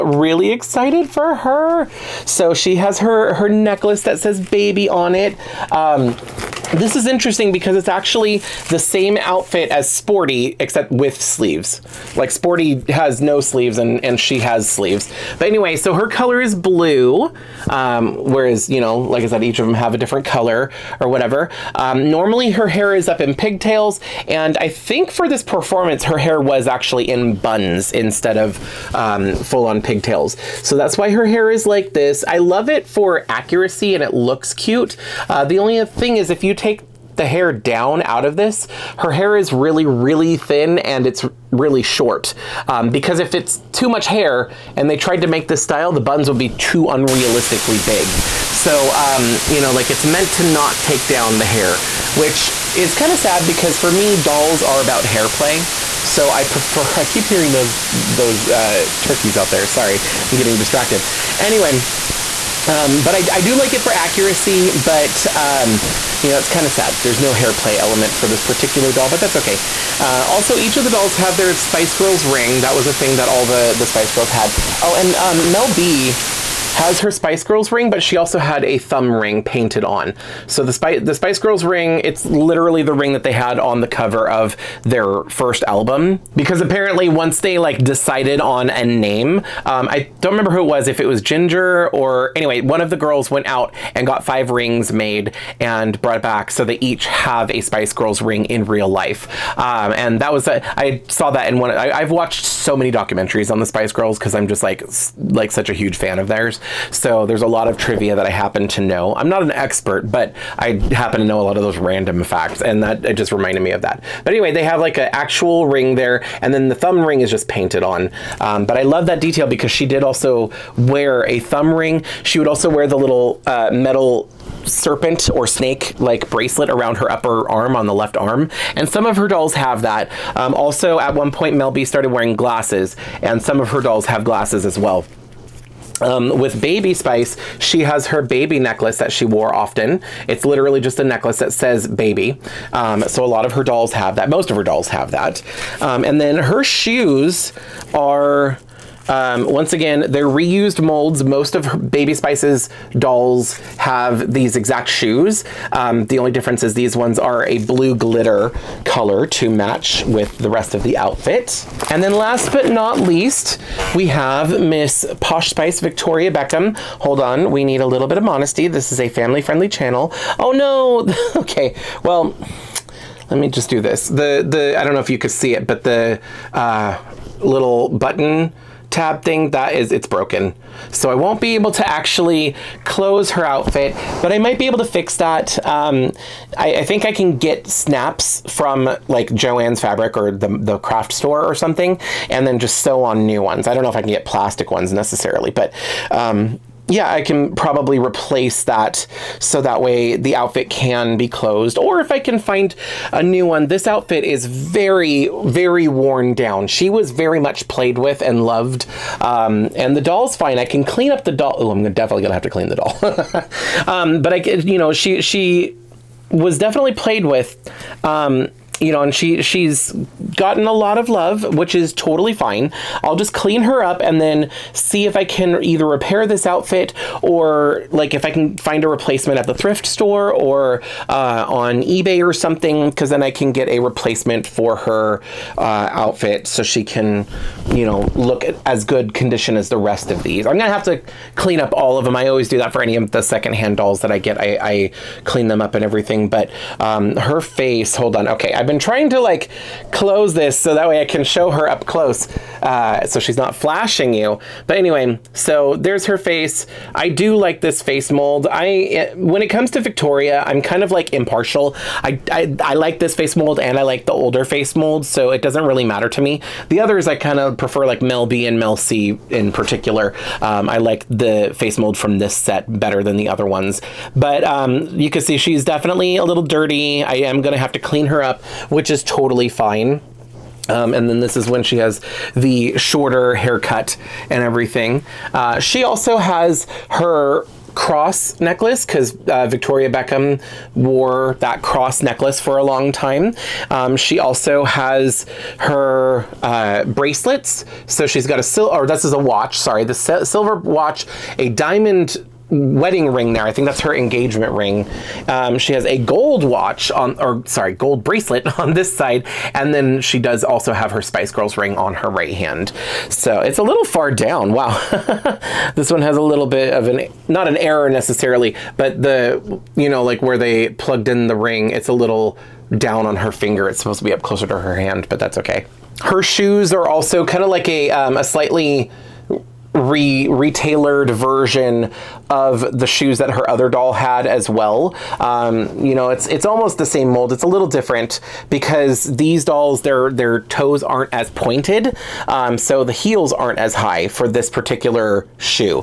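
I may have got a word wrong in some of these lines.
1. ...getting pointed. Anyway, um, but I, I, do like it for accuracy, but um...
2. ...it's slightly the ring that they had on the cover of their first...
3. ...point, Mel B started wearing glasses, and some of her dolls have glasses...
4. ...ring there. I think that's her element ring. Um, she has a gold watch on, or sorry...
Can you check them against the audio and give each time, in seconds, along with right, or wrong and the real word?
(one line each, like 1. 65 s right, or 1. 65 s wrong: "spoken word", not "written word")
1. 60 s wrong: "distracted", not "pointed"
2. 82 s wrong: "literally", not "slightly"
3. 131 s right
4. 303 s wrong: "engagement", not "element".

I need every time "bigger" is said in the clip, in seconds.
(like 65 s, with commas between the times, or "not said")
not said.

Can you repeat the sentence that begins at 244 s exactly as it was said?
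I, I clean them up and everything, but um, her face.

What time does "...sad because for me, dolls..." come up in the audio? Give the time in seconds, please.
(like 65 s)
53 s.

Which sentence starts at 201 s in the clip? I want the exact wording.
Or if I can find a new one, this outfit is very, very worn down.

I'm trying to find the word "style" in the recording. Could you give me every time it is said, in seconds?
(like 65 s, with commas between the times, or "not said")
45 s.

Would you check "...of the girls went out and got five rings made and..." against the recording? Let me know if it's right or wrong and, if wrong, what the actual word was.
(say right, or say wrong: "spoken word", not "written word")
right.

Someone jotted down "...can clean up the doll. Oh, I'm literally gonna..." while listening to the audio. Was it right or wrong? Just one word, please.
wrong.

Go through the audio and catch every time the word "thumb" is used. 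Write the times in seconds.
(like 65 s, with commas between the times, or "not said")
78 s, 116 s, 121 s.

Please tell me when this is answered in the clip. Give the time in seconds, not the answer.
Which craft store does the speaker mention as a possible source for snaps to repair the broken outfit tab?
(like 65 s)
189 s.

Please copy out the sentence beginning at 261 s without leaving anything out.
I, I, I like this face mold and I like the older face mold, so it doesn't really matter to me.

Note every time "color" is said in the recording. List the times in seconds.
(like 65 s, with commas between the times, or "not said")
16 s, 20 s, 158 s.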